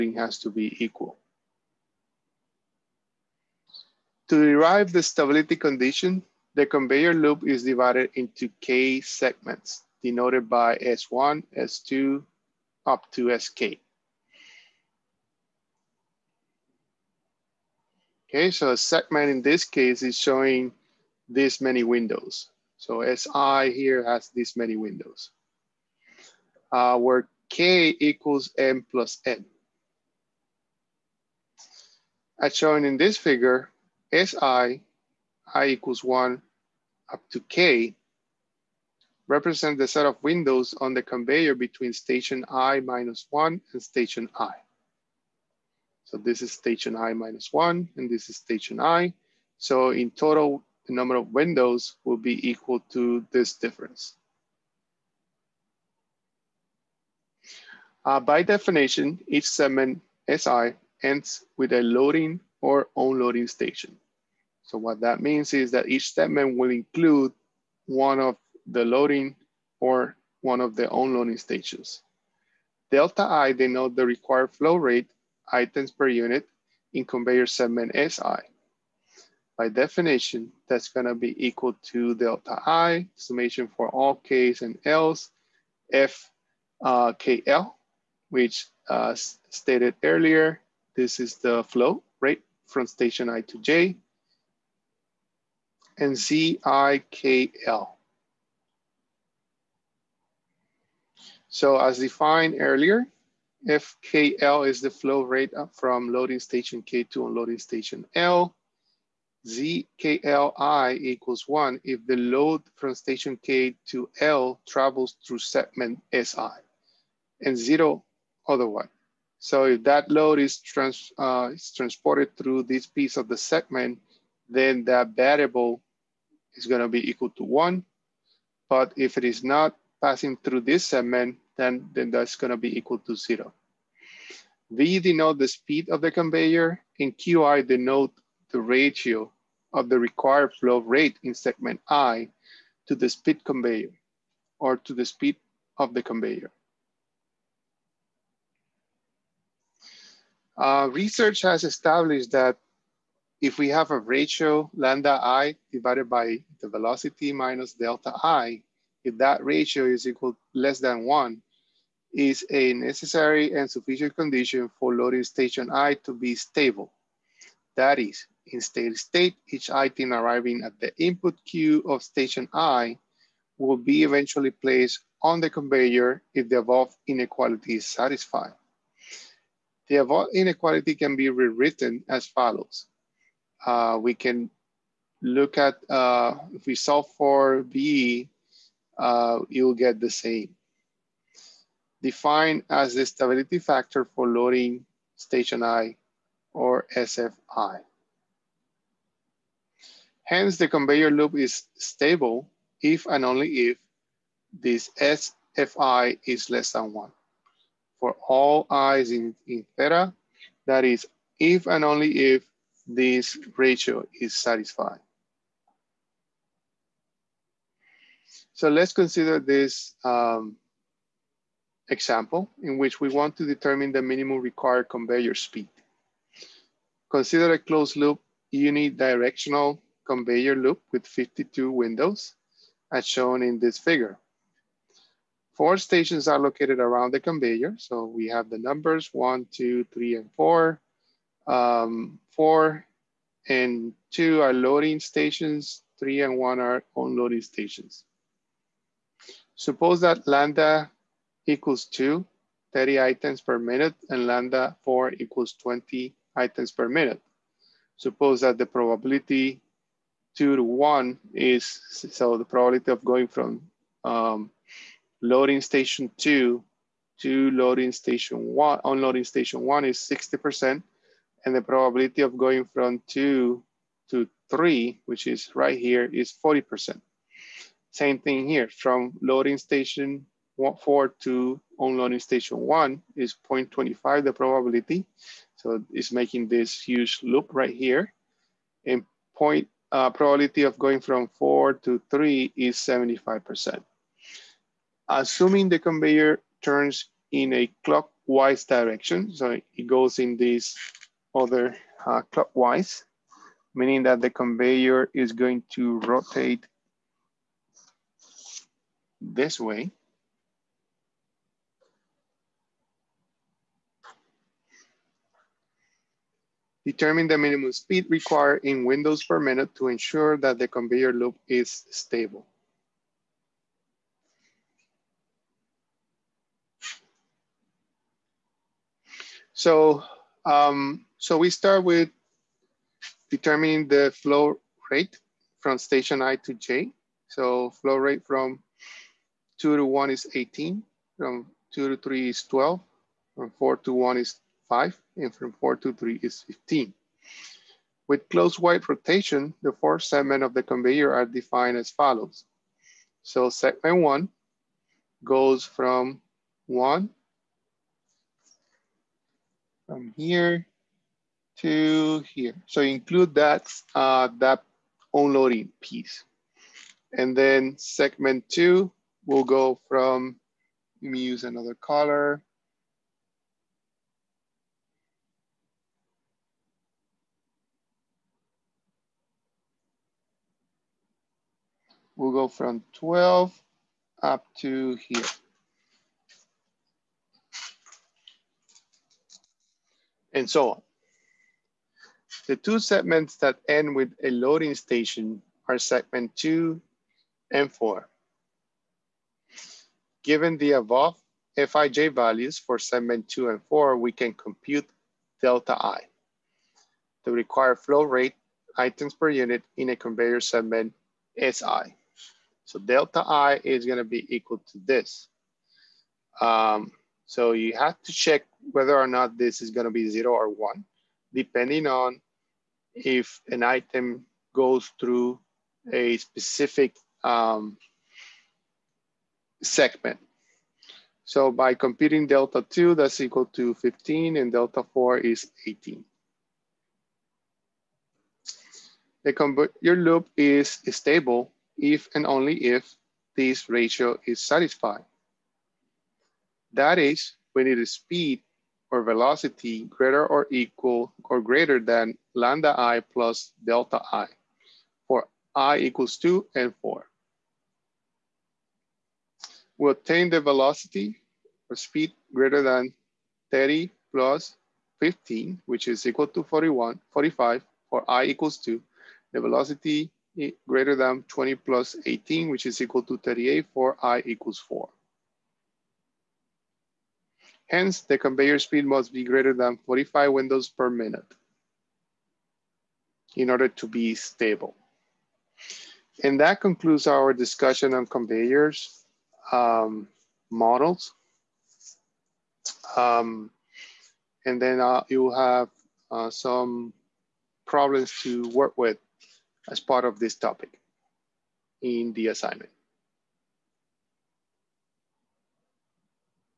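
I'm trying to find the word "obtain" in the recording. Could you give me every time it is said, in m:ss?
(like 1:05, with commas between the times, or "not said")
7:39.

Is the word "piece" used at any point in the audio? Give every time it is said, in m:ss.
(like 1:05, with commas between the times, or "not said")
2:02, 6:05.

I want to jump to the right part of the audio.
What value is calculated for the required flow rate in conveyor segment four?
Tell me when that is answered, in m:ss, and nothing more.
7:14.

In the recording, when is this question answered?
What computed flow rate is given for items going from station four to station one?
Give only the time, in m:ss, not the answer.
5:44.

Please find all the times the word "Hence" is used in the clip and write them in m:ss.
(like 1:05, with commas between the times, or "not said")
3:20, 7:57.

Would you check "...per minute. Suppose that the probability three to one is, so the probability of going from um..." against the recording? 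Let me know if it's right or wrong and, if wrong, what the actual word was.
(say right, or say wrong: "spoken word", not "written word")
wrong: "two", not "three".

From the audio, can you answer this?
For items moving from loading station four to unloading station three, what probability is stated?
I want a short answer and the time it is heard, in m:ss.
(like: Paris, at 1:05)
75%, at 4:52.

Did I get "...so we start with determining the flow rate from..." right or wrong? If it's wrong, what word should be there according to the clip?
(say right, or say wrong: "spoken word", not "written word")
right.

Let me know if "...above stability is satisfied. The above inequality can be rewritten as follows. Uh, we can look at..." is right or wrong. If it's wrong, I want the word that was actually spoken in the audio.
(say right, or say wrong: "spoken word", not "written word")
wrong: "inequality", not "stability".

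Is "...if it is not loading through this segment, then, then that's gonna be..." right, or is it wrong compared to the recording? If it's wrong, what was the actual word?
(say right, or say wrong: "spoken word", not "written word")
wrong: "passing", not "loading".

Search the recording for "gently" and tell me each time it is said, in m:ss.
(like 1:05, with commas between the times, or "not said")
not said.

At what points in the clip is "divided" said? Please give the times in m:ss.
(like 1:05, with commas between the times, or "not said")
0:07, 2:35.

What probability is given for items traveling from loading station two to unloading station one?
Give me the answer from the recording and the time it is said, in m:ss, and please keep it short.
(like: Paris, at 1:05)
60%, at 4:29.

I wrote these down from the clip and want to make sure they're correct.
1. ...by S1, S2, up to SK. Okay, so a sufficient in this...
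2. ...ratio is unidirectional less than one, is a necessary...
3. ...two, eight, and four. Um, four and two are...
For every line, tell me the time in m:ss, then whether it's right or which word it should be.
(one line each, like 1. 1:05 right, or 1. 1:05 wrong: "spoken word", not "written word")
1. 0:10 wrong: "segment", not "sufficient"
2. 2:39 wrong: "equal", not "unidirectional"
3. 3:59 wrong: "three", not "eight".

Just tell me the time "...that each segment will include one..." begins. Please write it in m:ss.
1:05.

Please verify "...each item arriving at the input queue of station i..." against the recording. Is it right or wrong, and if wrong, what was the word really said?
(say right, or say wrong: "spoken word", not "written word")
right.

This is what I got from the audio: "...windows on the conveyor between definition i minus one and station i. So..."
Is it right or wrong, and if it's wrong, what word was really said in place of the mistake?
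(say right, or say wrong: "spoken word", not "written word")
wrong: "station", not "definition".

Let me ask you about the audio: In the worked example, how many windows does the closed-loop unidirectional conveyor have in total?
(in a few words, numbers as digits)
52.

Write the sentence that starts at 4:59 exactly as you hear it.
So it goes in this other uh, clockwise, meaning that the conveyor is going to rotate this way.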